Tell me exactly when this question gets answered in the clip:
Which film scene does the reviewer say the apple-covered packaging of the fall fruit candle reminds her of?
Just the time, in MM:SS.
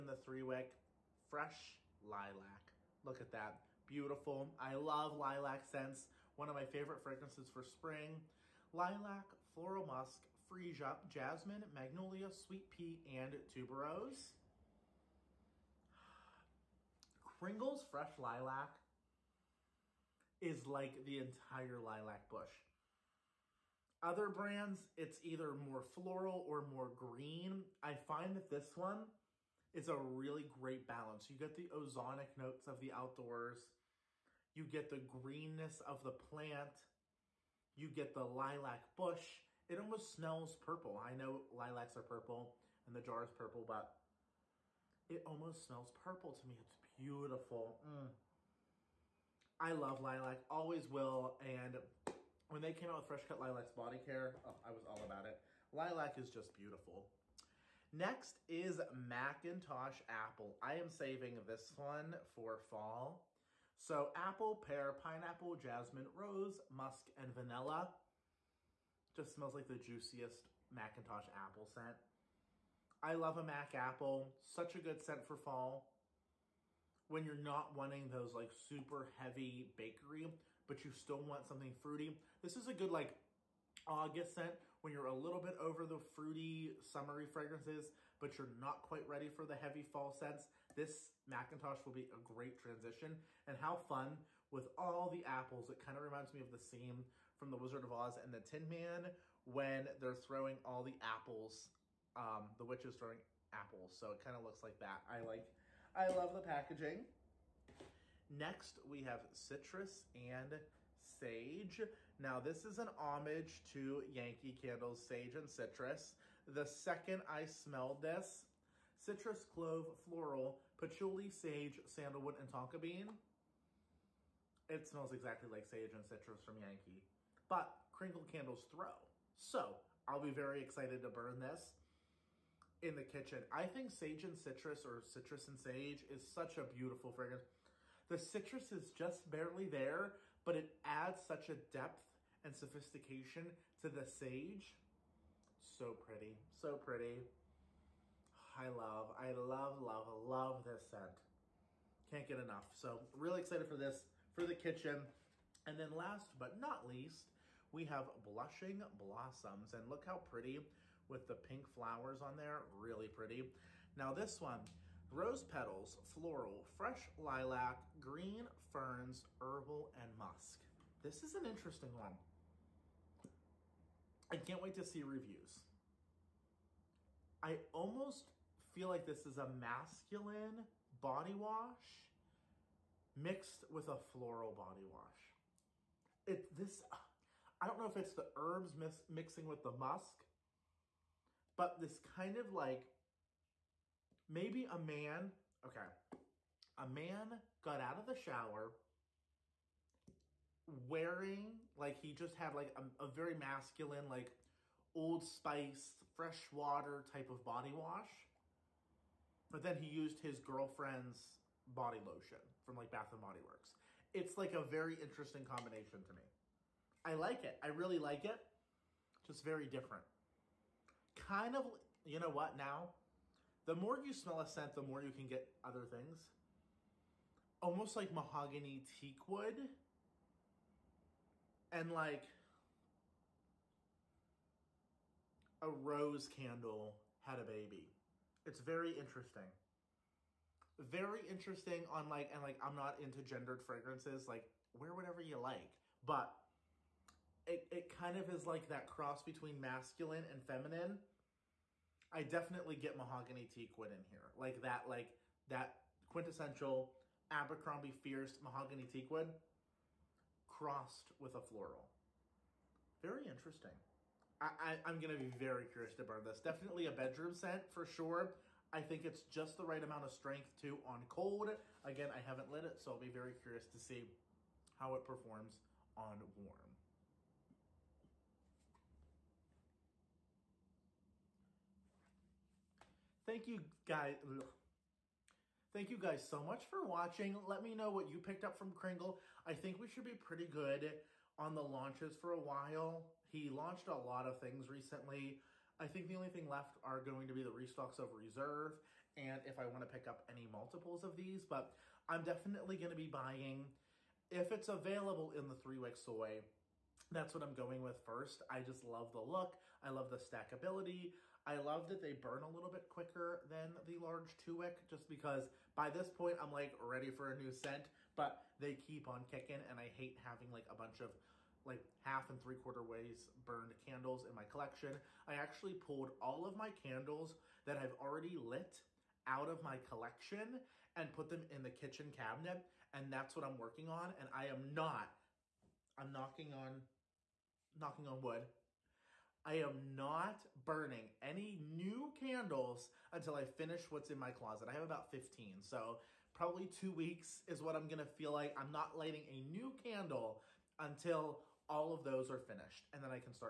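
01:37.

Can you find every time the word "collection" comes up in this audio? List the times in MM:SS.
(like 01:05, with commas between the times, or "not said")
05:24, 05:29.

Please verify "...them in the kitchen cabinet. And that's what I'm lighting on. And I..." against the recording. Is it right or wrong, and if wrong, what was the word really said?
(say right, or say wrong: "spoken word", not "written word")
wrong: "working", not "lighting".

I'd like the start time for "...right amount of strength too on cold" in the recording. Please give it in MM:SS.
04:29.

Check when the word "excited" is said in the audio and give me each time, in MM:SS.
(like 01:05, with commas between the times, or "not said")
02:10, 02:33.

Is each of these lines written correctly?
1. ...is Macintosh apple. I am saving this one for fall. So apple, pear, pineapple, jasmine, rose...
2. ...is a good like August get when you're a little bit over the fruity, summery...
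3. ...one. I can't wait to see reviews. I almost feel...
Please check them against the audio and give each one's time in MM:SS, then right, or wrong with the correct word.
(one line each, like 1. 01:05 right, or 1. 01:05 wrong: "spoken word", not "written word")
1. 00:58 right
2. 01:22 right
3. 02:51 right.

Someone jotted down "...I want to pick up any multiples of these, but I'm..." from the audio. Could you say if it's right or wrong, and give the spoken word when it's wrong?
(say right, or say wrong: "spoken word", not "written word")
right.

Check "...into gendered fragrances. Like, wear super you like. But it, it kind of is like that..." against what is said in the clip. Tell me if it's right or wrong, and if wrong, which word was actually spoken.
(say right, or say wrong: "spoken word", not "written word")
wrong: "whatever", not "super".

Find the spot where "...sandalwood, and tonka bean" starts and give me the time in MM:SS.
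02:01.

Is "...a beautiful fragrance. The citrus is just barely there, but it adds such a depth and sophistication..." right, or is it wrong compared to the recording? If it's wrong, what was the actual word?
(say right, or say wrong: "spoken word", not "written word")
right.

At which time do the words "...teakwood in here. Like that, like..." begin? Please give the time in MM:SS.
04:13.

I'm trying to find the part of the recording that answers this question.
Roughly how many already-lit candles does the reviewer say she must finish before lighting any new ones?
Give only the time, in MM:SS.
05:45.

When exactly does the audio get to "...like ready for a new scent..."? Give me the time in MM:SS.
05:16.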